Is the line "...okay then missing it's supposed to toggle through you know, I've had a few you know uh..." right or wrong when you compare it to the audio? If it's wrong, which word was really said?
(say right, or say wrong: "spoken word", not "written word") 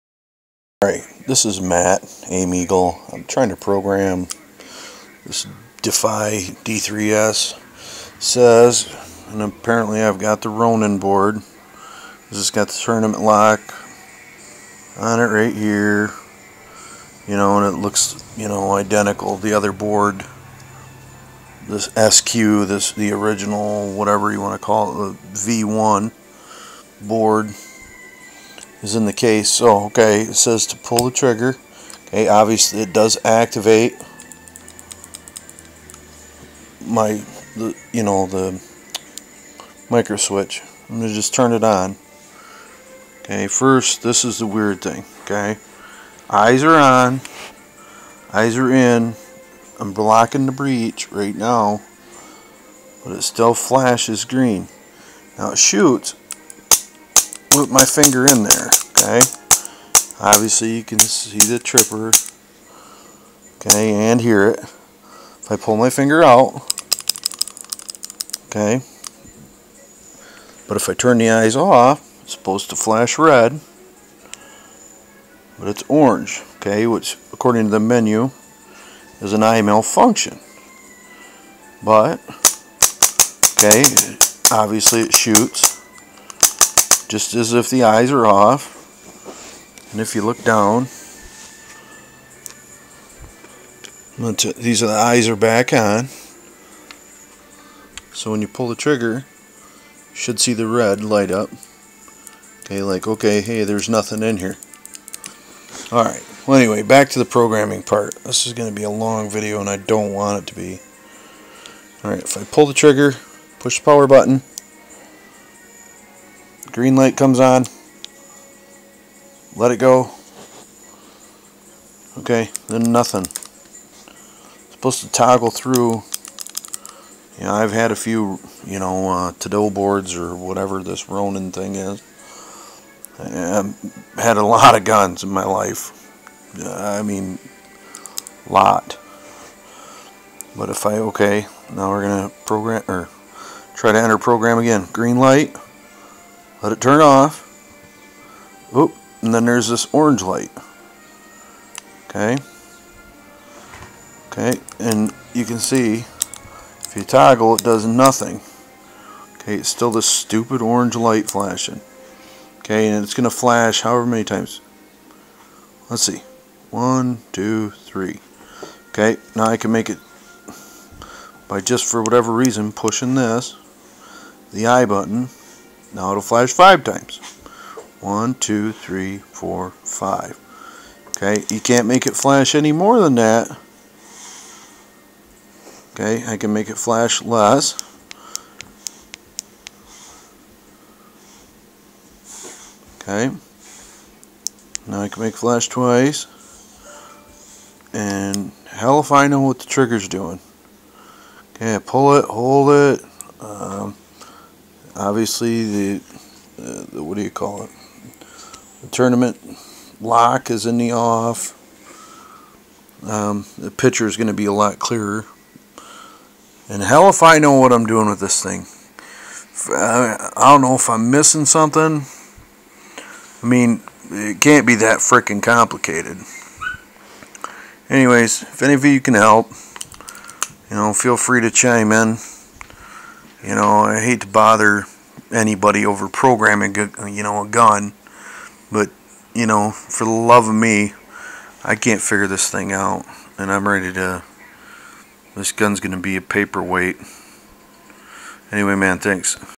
wrong: "nothing", not "missing".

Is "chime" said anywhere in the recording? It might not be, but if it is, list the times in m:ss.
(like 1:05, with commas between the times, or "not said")
3:51.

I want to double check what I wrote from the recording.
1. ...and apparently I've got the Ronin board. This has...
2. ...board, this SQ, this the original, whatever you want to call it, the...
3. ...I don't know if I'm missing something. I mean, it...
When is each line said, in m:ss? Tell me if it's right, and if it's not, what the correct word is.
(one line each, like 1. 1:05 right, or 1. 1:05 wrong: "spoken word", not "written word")
1. 0:09 right
2. 0:19 right
3. 3:40 right.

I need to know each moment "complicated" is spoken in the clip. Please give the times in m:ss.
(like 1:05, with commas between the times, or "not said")
3:45.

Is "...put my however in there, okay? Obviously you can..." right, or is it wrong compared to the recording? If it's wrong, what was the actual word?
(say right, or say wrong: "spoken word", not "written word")
wrong: "finger", not "however".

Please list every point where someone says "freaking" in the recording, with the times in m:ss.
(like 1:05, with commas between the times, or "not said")
3:45.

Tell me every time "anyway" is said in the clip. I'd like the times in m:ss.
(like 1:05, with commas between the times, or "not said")
1:46, 3:47, 4:08.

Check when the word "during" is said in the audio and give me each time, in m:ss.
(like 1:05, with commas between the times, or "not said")
not said.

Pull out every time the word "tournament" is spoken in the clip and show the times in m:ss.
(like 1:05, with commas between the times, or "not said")
0:12, 3:28.